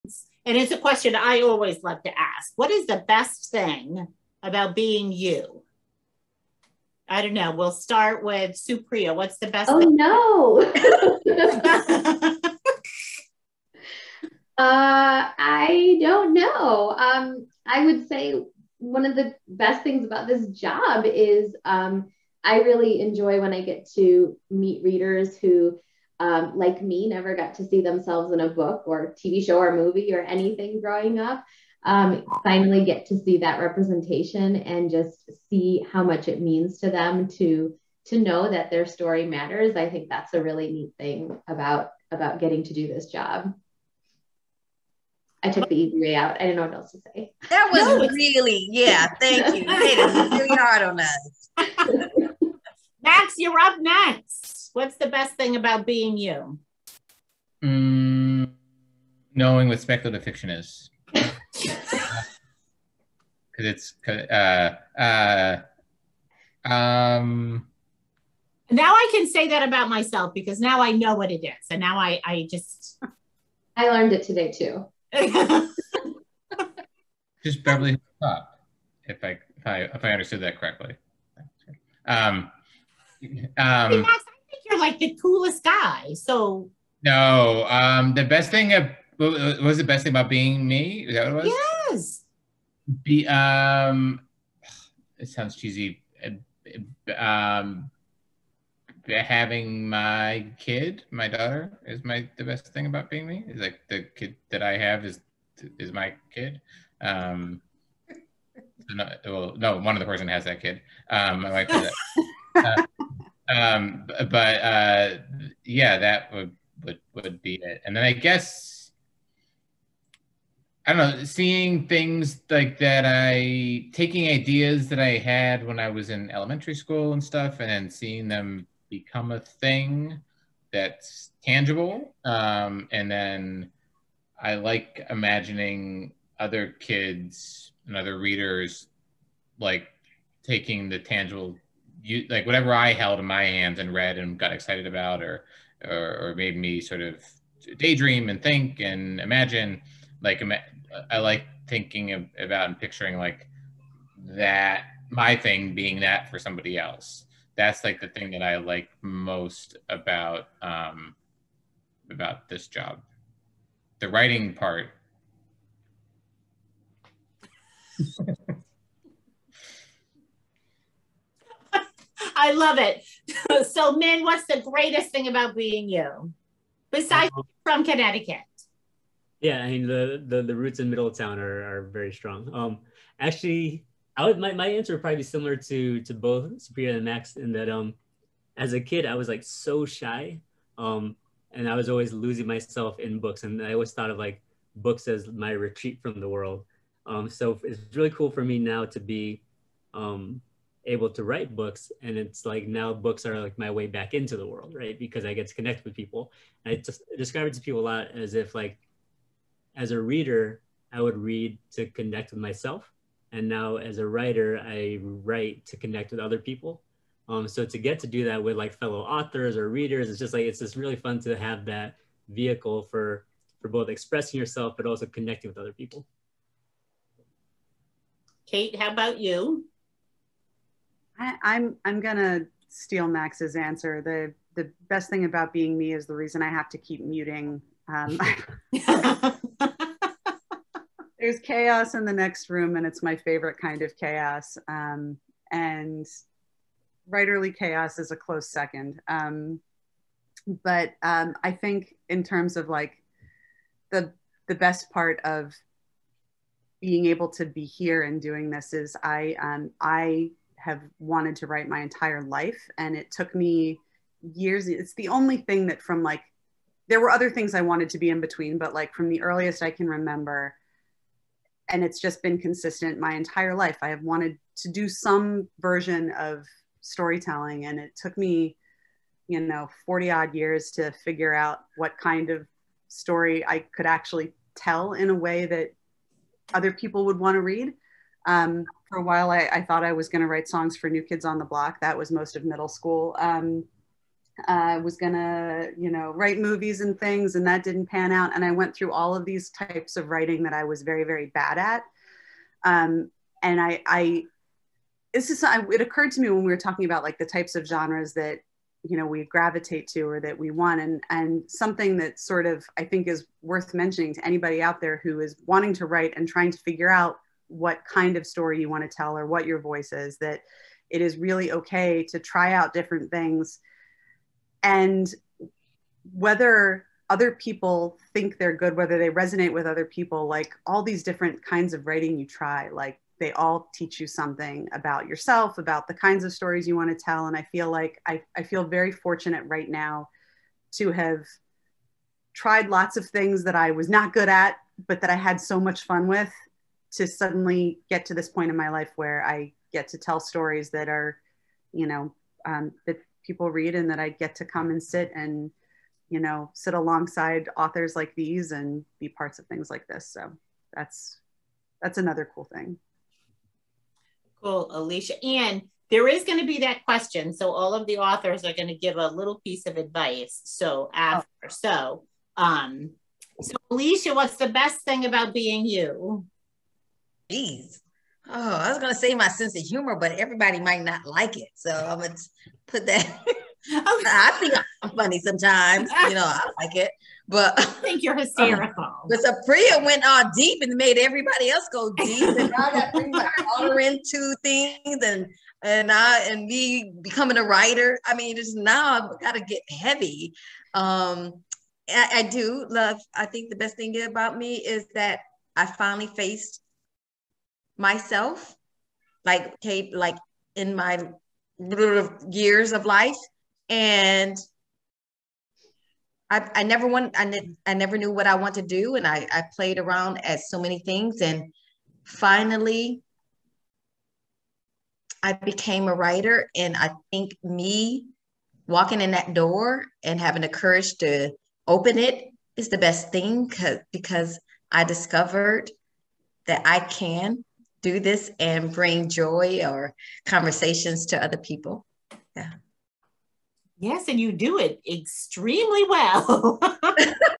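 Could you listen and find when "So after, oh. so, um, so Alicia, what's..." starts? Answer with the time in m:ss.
6:10.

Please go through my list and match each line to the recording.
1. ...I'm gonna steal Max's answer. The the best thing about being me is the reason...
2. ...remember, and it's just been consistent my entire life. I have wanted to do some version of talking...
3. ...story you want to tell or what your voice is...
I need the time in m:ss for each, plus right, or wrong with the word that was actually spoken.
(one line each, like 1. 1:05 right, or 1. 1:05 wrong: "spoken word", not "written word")
1. 3:51 right
2. 4:29 wrong: "storytelling", not "talking"
3. 5:18 right.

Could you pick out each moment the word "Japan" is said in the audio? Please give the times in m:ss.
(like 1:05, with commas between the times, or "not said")
not said.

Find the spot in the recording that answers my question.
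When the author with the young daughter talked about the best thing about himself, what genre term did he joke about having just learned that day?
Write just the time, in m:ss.
0:59.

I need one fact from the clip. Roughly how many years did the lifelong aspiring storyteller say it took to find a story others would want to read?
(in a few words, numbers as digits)
40.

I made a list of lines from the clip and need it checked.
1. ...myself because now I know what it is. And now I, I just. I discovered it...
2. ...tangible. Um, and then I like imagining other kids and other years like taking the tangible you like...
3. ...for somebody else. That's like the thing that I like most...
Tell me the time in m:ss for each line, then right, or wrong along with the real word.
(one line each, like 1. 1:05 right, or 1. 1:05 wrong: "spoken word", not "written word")
1. 1:09 wrong: "learned", not "discovered"
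2. 2:11 wrong: "readers", not "years"
3. 2:36 right.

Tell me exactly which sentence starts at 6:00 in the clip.
So that's, that's another cool thing.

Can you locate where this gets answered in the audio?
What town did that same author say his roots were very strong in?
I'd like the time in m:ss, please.
3:00.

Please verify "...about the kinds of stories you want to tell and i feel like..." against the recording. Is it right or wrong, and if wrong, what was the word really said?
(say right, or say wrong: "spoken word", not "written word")
right.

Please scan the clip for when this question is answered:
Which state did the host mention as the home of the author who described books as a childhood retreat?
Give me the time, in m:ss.
2:57.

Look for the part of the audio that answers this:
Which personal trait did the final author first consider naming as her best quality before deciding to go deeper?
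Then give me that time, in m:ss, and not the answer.
6:19.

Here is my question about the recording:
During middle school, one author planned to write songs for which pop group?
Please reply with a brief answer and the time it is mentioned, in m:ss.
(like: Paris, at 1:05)
New Kids on the Block, at 4:50.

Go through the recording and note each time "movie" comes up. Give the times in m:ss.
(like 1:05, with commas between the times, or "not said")
0:29, 4:56.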